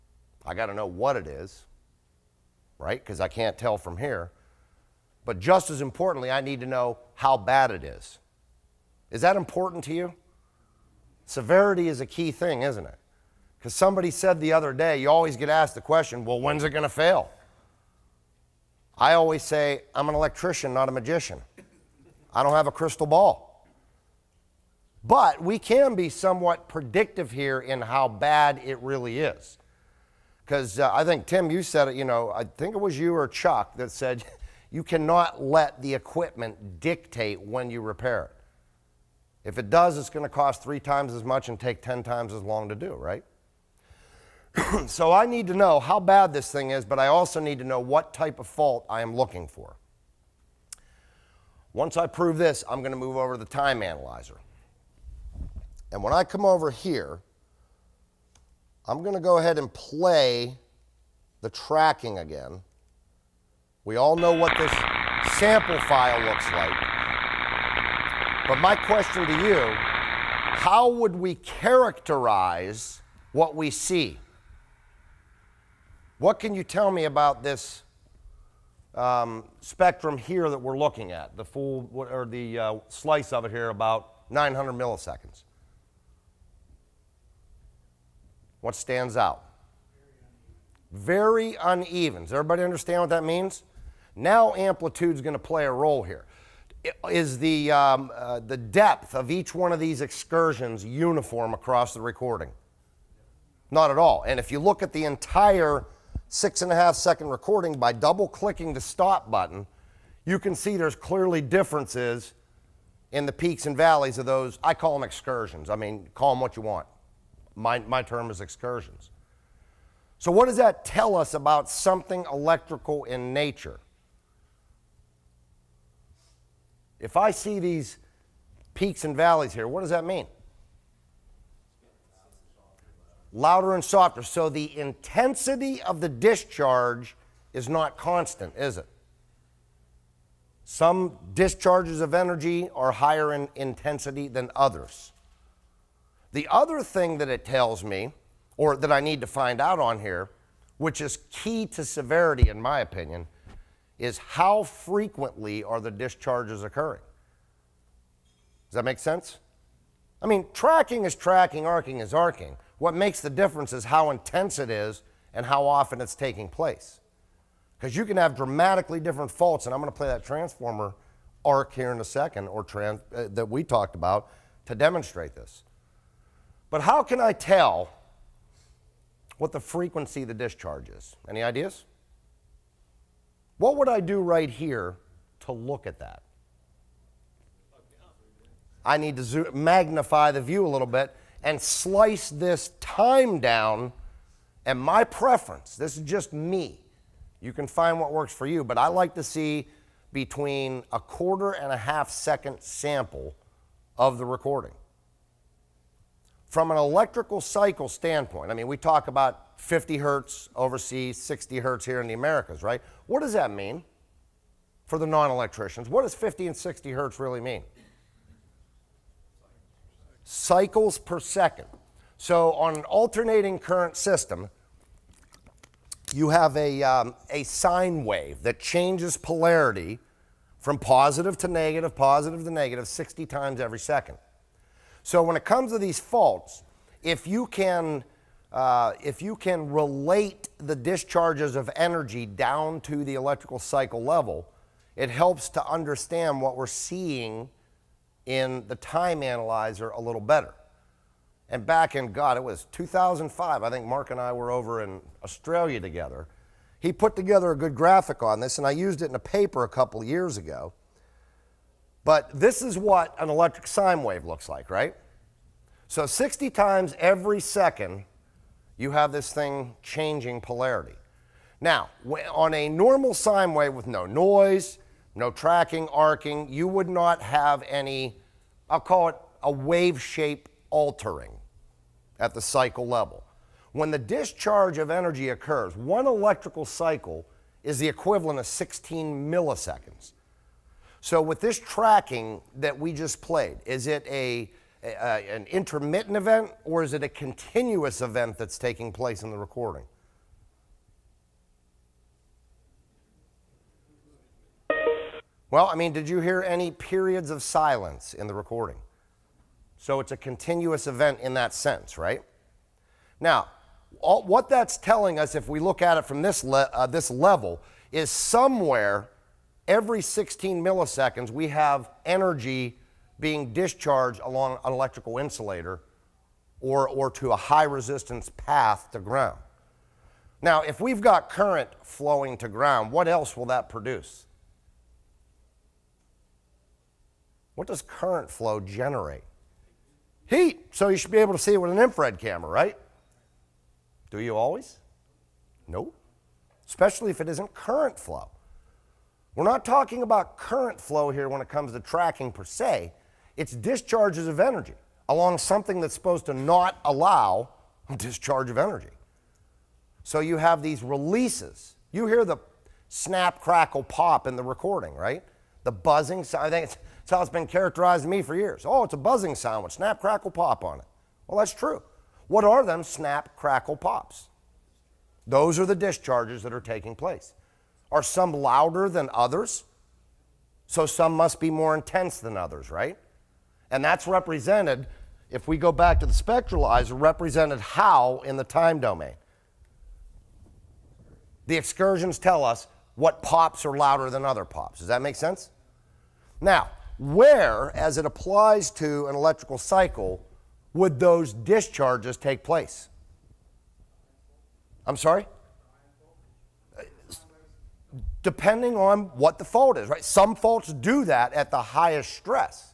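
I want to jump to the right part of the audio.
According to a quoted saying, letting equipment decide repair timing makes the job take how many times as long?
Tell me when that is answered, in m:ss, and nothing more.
0:41.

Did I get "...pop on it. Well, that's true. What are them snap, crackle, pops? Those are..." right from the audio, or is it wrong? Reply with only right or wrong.
right.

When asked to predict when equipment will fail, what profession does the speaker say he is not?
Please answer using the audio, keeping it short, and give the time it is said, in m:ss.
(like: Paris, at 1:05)
magician, at 0:20.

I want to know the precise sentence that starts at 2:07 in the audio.
If I see these peaks and valleys here, what does that mean?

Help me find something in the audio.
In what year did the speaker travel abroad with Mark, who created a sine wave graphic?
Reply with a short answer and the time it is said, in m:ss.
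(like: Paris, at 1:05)
2005, at 4:12.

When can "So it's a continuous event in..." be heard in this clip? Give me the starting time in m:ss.
5:09.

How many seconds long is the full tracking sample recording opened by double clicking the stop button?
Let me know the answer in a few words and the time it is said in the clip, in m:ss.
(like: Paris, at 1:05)
6.5 seconds, at 1:46.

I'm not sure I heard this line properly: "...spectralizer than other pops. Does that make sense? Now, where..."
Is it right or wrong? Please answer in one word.
wrong.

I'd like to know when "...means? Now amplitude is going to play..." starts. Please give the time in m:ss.
1:33.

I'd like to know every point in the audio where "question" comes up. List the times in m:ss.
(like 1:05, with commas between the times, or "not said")
0:15, 1:08.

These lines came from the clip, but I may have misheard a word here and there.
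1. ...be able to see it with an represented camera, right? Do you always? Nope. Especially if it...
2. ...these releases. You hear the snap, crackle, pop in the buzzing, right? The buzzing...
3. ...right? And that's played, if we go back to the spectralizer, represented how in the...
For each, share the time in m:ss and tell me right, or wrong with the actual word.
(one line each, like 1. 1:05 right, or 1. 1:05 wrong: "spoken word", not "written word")
1. 5:41 wrong: "infrared", not "represented"
2. 6:00 wrong: "recording", not "buzzing"
3. 6:22 wrong: "represented", not "played".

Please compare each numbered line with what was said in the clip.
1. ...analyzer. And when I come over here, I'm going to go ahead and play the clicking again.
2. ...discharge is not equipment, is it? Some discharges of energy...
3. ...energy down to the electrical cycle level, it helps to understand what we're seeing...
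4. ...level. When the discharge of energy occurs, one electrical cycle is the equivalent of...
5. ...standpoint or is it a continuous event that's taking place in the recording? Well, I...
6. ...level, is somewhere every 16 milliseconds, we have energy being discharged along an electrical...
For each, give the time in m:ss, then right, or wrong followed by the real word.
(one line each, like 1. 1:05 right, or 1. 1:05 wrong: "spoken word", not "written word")
1. 0:53 wrong: "tracking", not "clicking"
2. 2:16 wrong: "constant", not "equipment"
3. 4:01 right
4. 4:42 right
5. 4:56 wrong: "event", not "standpoint"
6. 5:17 right.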